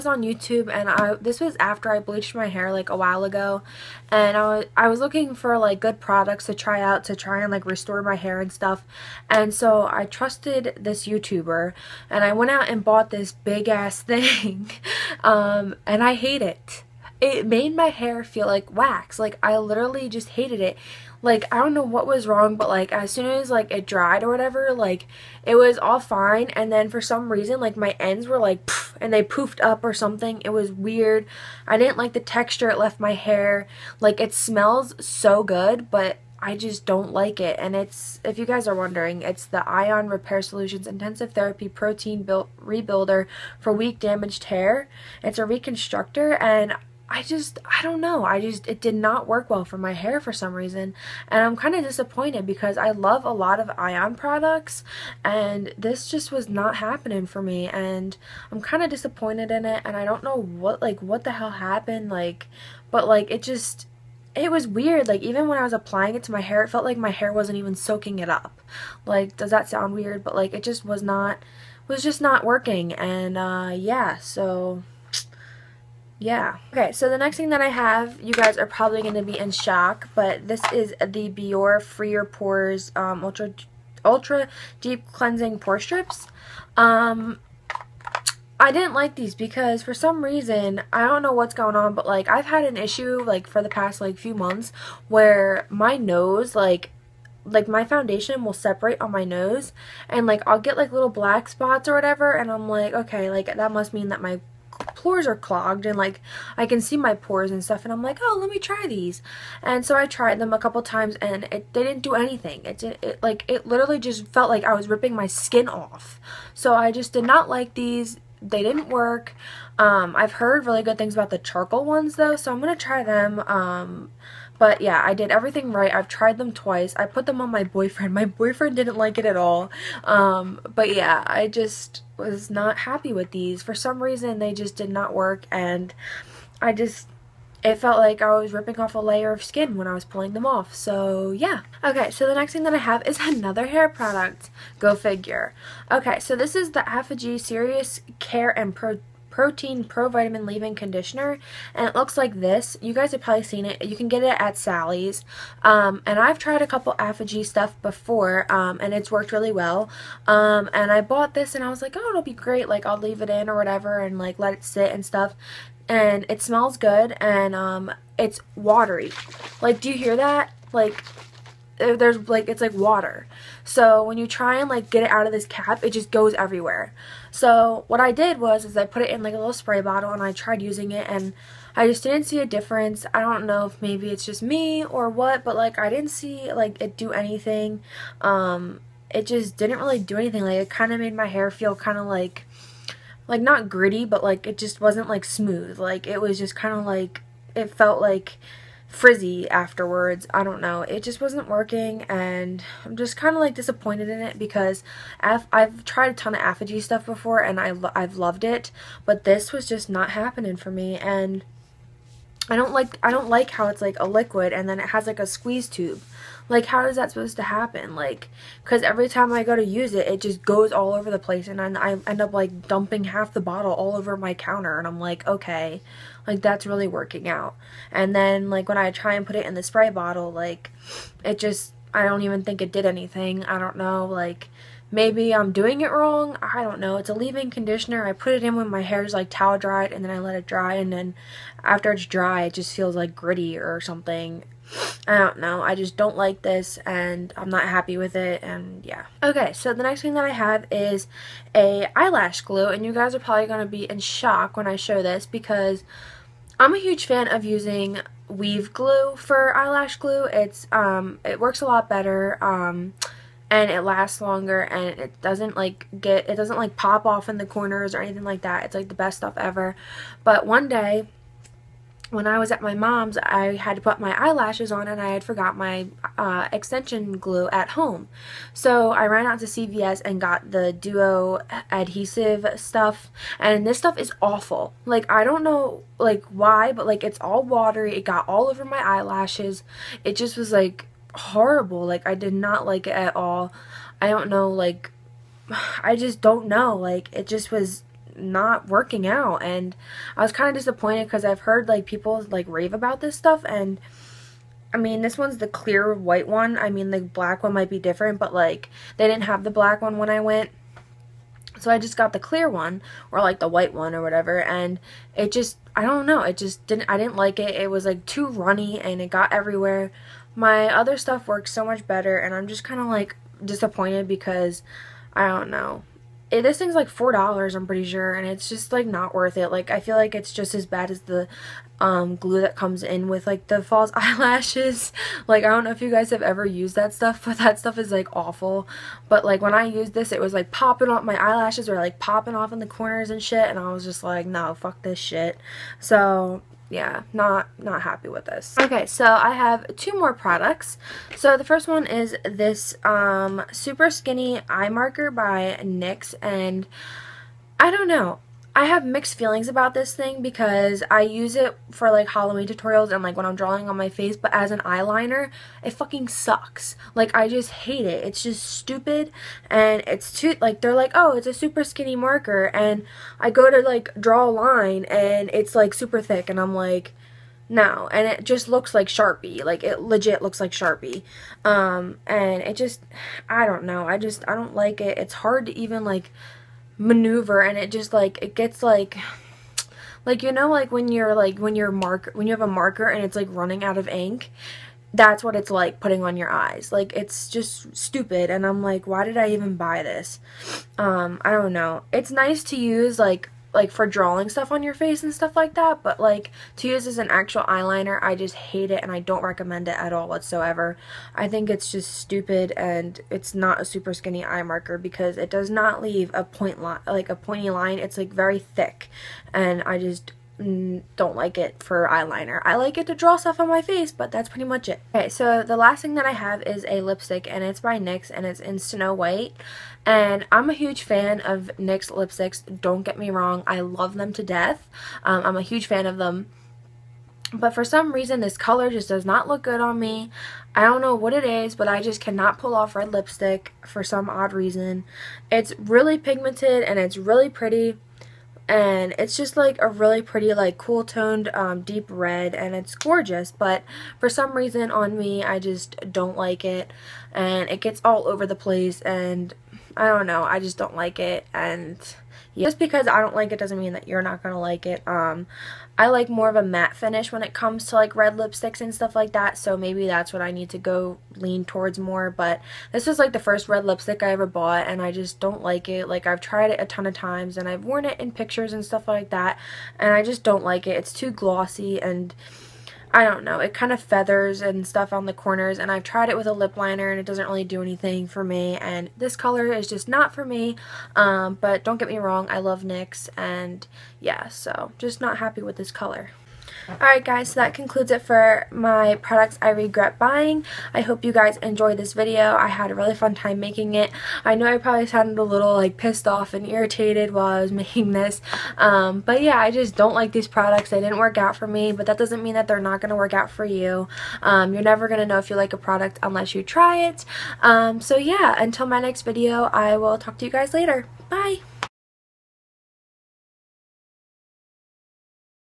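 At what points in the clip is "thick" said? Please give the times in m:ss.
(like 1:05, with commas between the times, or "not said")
6:16, 6:58.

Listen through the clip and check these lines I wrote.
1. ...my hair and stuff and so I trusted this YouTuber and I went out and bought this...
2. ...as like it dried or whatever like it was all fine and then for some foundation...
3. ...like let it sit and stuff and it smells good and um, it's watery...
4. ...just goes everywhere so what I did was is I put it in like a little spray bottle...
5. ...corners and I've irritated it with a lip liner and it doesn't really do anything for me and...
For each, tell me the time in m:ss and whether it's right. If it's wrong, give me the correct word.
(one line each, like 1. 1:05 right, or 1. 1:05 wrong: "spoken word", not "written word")
1. 0:08 right
2. 0:23 wrong: "reason", not "foundation"
3. 2:44 right
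4. 2:55 right
5. 8:05 wrong: "tried", not "irritated".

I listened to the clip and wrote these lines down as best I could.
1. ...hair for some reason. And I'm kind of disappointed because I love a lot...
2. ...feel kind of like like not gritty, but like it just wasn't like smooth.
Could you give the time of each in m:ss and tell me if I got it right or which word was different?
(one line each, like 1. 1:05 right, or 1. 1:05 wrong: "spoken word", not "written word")
1. 0:49 right
2. 3:11 right.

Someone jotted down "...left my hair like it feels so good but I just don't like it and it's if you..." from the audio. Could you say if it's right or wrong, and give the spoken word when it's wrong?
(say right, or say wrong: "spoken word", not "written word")
wrong: "smells", not "feels".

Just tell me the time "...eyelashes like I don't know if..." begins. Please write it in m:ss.
5:33.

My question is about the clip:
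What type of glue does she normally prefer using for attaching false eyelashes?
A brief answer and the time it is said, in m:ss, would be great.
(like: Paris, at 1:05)
weave glue, at 4:18.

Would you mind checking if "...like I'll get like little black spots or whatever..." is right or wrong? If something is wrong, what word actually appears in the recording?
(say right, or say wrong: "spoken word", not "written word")
right.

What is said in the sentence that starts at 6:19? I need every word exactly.
Like it legit looks like Sharpie.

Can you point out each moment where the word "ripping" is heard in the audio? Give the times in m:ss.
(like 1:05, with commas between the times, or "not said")
1:54, 2:18.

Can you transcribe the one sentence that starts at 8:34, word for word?
Um, you're never going to know if you like a product unless you try it.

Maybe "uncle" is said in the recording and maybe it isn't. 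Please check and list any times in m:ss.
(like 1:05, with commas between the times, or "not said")
not said.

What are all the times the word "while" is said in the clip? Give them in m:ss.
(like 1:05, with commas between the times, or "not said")
0:02, 8:27.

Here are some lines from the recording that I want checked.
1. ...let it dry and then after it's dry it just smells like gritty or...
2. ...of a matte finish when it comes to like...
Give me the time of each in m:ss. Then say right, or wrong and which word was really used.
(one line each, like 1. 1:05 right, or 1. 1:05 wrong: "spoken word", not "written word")
1. 4:00 wrong: "feels", not "smells"
2. 7:46 right.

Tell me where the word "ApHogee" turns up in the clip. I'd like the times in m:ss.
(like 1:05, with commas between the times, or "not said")
2:26, 2:36, 3:26.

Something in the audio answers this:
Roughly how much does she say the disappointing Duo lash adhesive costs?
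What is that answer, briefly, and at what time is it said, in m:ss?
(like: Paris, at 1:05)
4 dollars, at 5:26.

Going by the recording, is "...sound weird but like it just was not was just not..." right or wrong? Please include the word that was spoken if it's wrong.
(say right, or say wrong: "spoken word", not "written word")
right.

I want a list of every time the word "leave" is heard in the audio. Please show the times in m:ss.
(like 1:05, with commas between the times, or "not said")
2:30, 2:42, 3:57, 6:55.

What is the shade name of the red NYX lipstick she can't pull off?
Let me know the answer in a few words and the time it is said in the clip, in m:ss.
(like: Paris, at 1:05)
Snow White, at 7:08.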